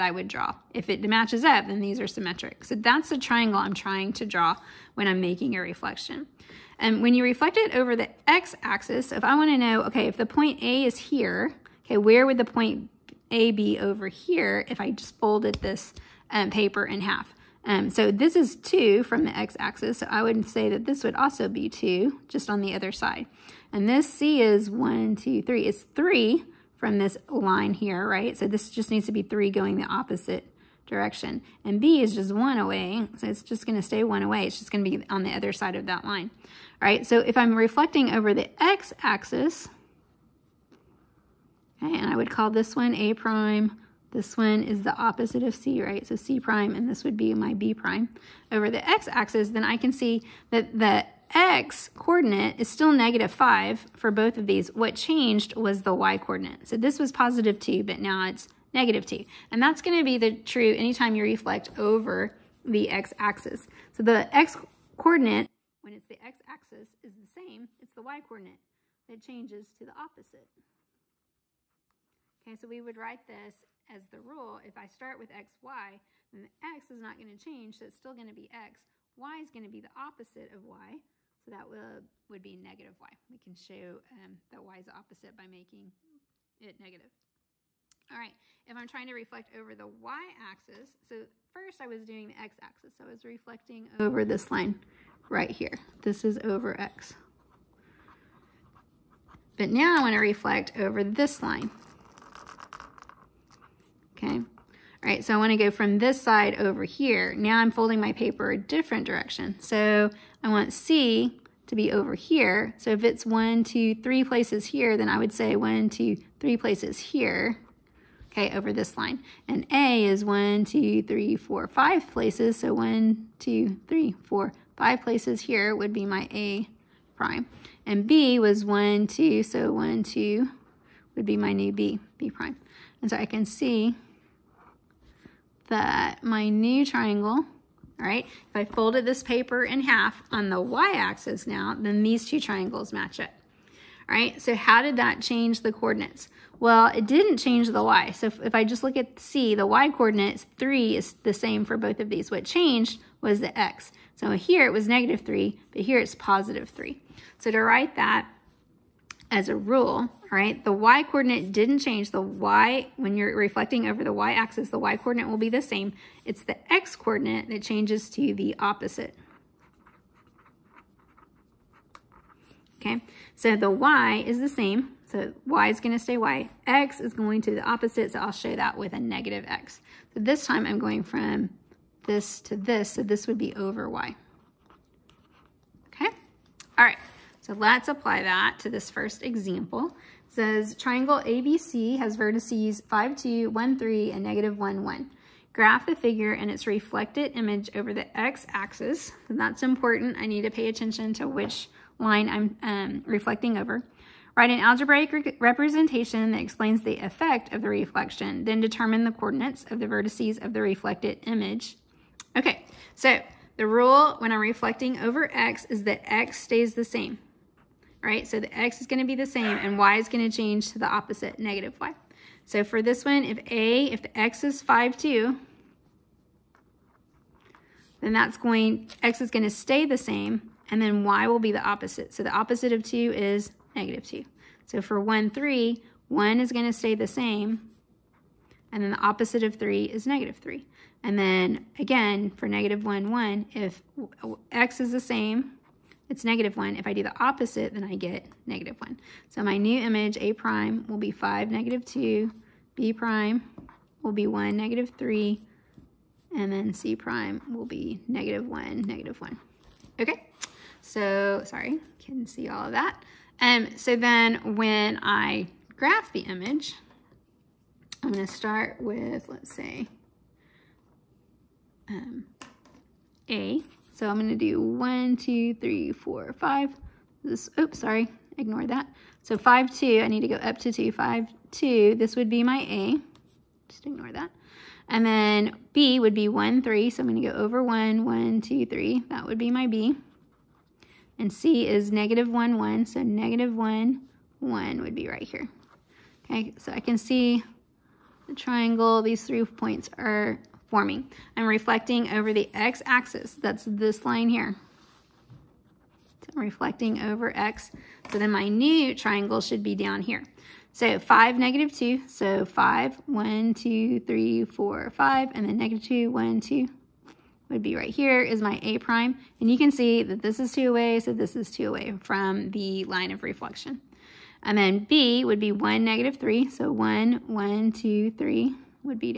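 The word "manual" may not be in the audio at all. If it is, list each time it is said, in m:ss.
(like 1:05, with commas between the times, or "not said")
not said.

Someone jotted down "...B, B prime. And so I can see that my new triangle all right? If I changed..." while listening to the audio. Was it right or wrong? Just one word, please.
wrong.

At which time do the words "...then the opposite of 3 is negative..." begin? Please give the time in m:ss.
3:58.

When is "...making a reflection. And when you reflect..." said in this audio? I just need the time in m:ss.
0:05.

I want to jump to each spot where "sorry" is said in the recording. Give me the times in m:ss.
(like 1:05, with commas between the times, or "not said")
4:21, 4:37.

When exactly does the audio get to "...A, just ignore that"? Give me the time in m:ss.
4:42.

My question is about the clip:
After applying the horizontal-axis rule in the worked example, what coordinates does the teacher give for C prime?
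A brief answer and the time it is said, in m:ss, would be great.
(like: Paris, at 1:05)
(-1, -1), at 4:18.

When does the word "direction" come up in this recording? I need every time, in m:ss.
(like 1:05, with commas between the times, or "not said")
0:30, 1:49.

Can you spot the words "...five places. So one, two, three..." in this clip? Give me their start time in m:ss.
2:01.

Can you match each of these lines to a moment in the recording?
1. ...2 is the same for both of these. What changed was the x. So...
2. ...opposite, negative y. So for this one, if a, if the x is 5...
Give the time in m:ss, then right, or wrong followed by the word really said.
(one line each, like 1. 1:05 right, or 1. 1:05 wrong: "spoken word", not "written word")
1. 2:30 wrong: "3", not "2"
2. 3:40 right.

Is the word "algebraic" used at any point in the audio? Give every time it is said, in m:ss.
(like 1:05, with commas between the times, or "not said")
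3:24.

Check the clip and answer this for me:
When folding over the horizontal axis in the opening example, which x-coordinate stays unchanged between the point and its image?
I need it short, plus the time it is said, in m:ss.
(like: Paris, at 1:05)
-5, at 0:52.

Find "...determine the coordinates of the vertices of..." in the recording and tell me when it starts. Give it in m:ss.
3:28.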